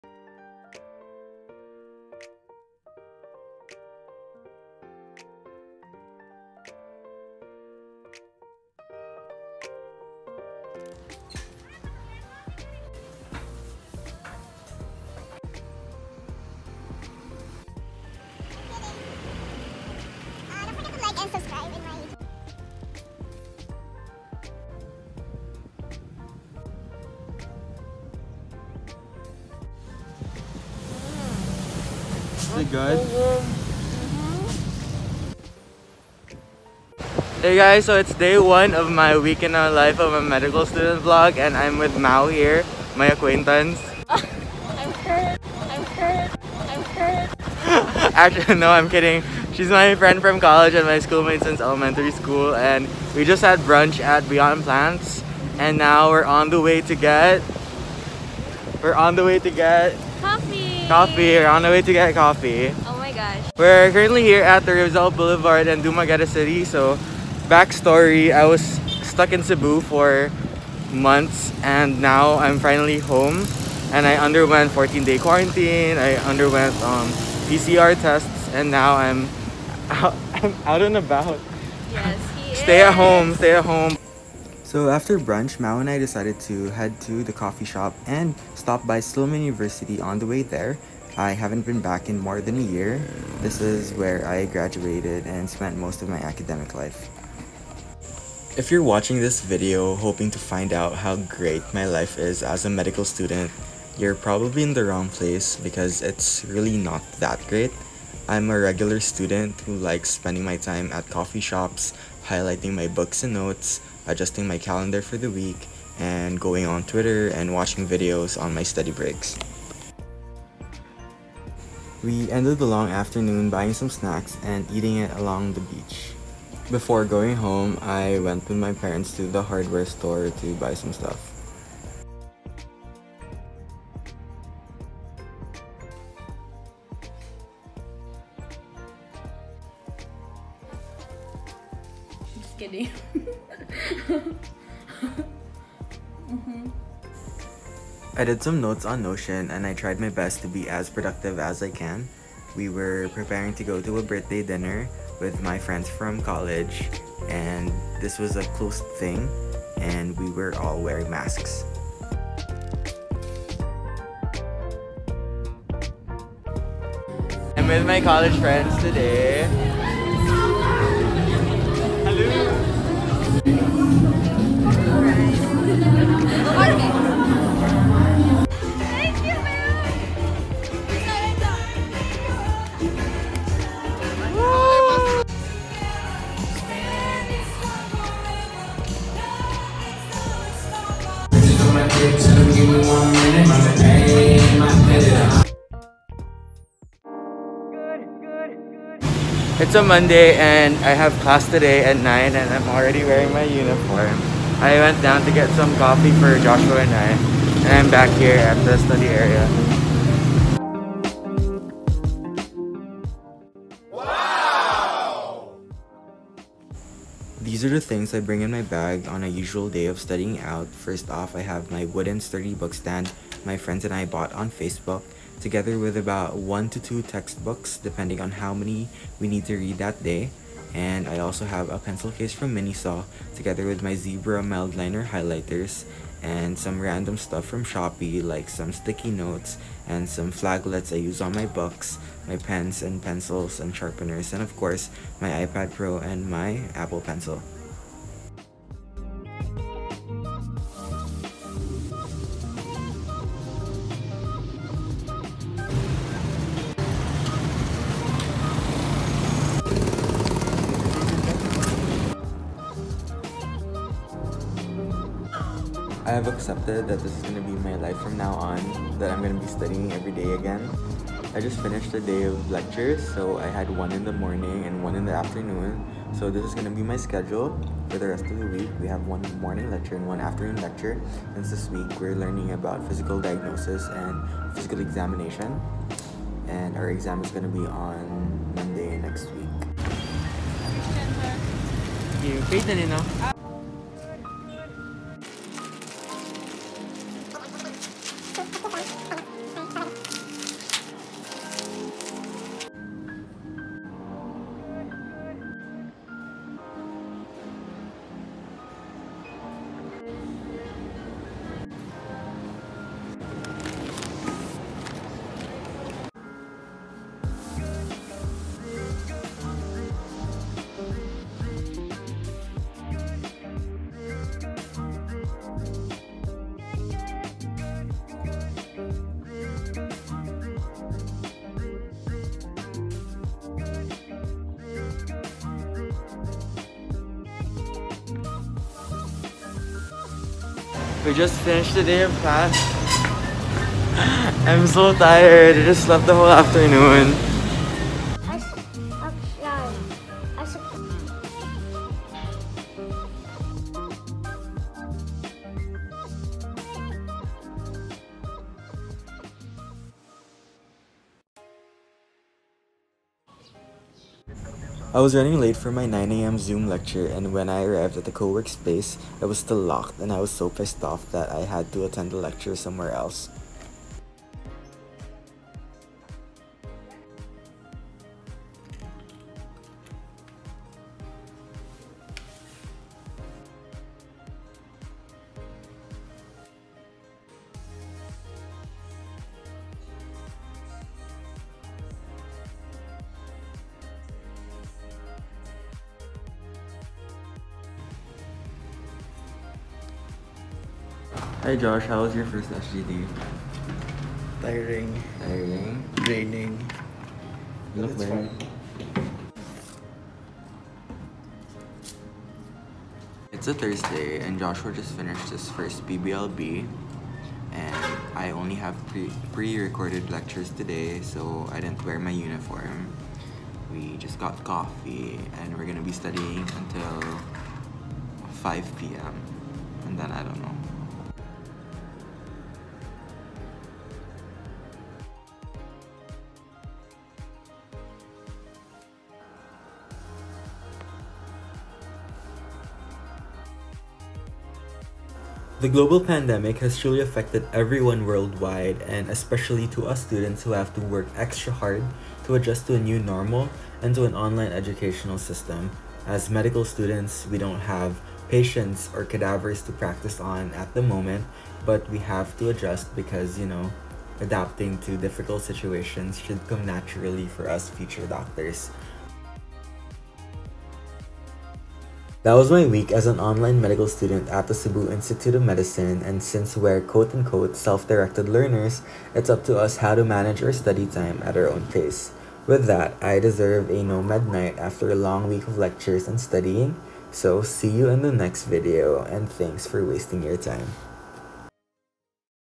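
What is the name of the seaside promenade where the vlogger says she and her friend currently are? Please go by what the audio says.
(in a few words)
Rizal Boulevard.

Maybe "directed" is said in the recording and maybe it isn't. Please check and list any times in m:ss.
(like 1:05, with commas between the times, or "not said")
7:57.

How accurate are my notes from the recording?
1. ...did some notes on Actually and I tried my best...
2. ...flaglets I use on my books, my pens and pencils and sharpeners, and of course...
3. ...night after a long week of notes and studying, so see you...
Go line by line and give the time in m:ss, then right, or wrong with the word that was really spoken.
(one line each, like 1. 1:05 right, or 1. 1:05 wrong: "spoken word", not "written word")
1. 2:28 wrong: "Notion", not "Actually"
2. 4:00 right
3. 8:04 wrong: "lectures", not "notes".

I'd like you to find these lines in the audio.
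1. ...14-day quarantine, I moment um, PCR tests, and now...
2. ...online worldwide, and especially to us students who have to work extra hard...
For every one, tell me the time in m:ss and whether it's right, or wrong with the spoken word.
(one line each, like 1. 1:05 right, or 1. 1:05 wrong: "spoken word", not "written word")
1. 1:14 wrong: "underwent", not "moment"
2. 7:27 wrong: "everyone", not "online".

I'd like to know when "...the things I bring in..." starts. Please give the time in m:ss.
3:37.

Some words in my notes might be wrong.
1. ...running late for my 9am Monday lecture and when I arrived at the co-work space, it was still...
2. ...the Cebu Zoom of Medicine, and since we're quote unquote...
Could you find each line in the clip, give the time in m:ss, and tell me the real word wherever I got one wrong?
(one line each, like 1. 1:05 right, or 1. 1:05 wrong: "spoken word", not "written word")
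1. 6:05 wrong: "Zoom", not "Monday"
2. 7:54 wrong: "Institute", not "Zoom".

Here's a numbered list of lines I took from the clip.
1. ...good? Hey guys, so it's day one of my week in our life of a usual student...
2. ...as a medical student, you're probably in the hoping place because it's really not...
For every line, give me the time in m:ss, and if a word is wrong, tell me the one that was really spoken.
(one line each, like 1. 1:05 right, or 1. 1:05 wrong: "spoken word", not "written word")
1. 0:32 wrong: "medical", not "usual"
2. 1:42 wrong: "wrong", not "hoping".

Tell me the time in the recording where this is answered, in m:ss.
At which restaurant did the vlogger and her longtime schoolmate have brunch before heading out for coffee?
0:54.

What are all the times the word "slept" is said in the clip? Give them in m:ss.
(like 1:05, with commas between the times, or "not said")
5:45.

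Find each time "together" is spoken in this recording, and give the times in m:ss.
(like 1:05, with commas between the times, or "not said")
3:45, 3:53.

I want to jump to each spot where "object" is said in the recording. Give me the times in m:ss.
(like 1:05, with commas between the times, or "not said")
not said.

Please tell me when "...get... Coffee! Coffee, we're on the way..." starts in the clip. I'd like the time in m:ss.
0:59.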